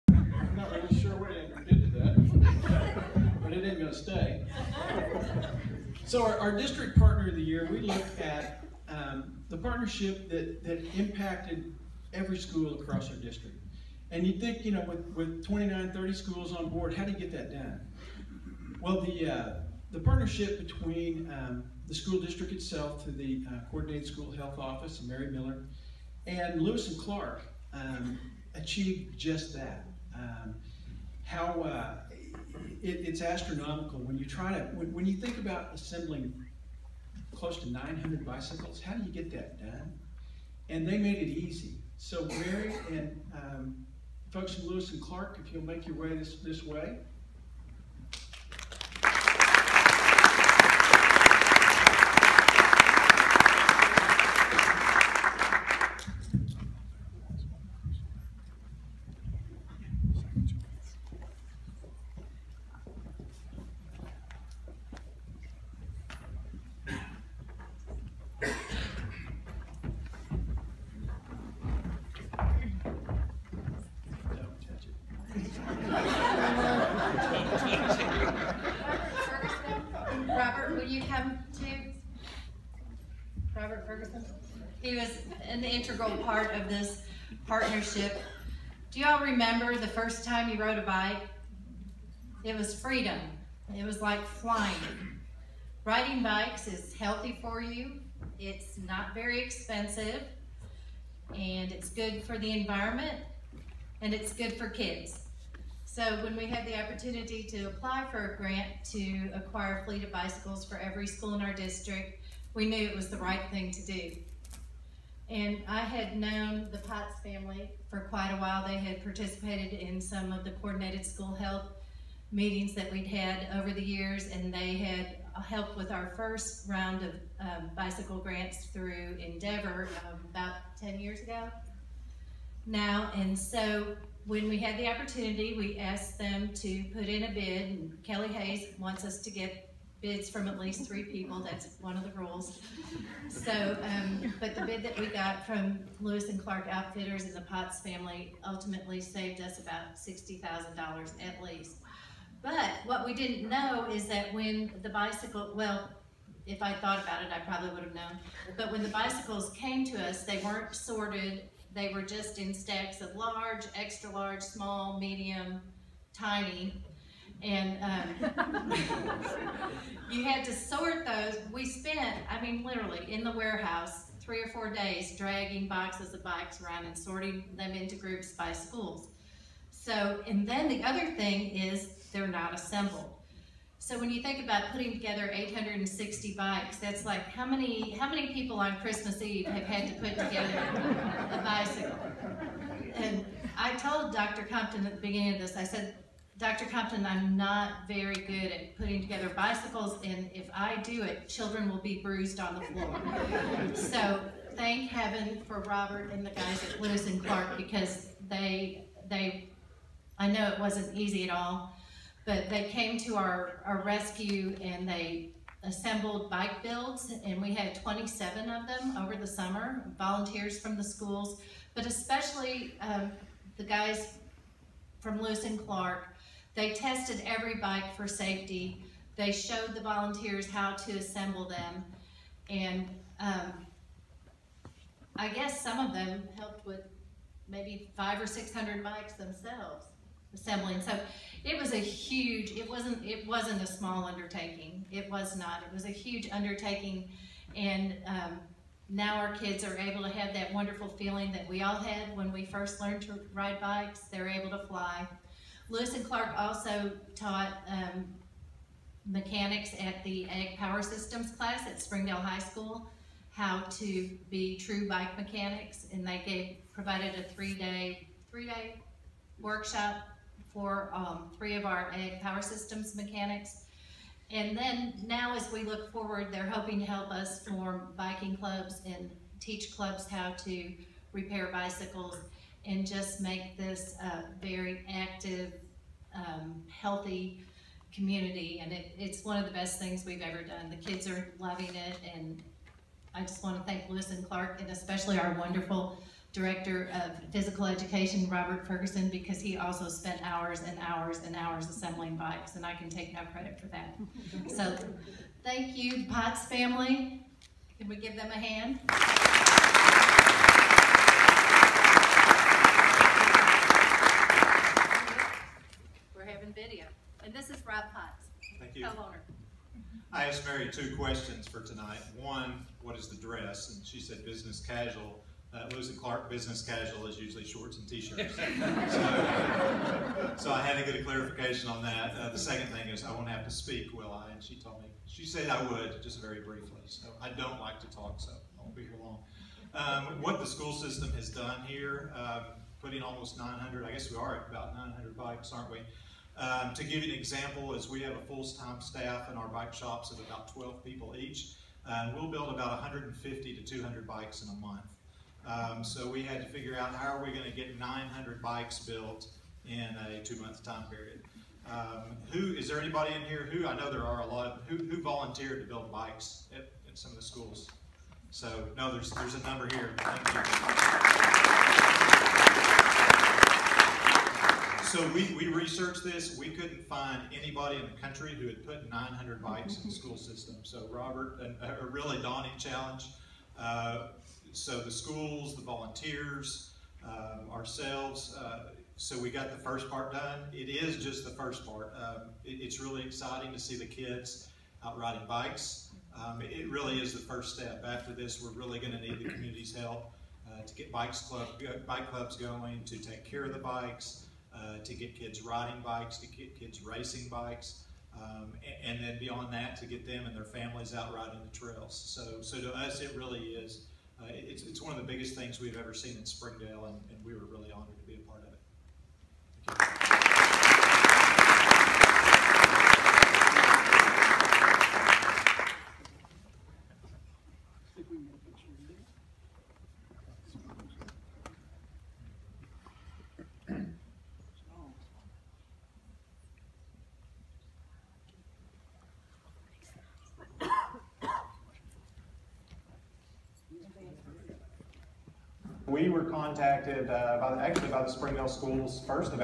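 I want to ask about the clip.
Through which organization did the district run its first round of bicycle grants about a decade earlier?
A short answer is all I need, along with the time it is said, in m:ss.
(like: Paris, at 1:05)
Endeavor, at 2:09.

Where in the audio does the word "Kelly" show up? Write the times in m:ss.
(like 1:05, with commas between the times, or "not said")
2:18.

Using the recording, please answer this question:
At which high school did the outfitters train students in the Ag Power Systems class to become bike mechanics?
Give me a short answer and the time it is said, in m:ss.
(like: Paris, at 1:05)
Springdale High School, at 4:21.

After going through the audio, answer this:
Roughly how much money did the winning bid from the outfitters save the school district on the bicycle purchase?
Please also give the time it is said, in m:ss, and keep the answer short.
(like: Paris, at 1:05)
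$60,000, at 2:29.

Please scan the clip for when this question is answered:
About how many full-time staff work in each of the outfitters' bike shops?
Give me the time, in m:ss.
5:50.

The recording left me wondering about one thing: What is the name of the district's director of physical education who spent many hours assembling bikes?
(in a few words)
Robert Ferguson.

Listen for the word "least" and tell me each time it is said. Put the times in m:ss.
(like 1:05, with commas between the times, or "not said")
2:20, 2:31.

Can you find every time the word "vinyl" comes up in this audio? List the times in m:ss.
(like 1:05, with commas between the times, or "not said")
not said.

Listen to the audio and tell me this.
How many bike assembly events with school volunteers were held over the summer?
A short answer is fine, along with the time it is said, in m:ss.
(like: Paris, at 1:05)
27, at 3:37.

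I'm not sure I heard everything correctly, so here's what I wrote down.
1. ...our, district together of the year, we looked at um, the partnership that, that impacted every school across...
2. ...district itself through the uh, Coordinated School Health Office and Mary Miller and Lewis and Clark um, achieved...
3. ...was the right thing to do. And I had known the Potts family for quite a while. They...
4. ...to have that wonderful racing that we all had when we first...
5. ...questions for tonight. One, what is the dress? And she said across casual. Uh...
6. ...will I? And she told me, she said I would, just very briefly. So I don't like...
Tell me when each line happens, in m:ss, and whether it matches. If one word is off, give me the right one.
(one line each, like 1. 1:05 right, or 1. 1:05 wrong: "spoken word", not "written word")
1. 0:06 wrong: "partner", not "together"
2. 0:22 right
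3. 1:52 right
4. 4:10 wrong: "feeling", not "racing"
5. 5:20 wrong: "business", not "across"
6. 5:33 right.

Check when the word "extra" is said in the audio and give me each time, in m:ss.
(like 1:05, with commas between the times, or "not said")
2:43.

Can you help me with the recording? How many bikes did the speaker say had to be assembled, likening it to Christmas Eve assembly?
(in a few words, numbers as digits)
860.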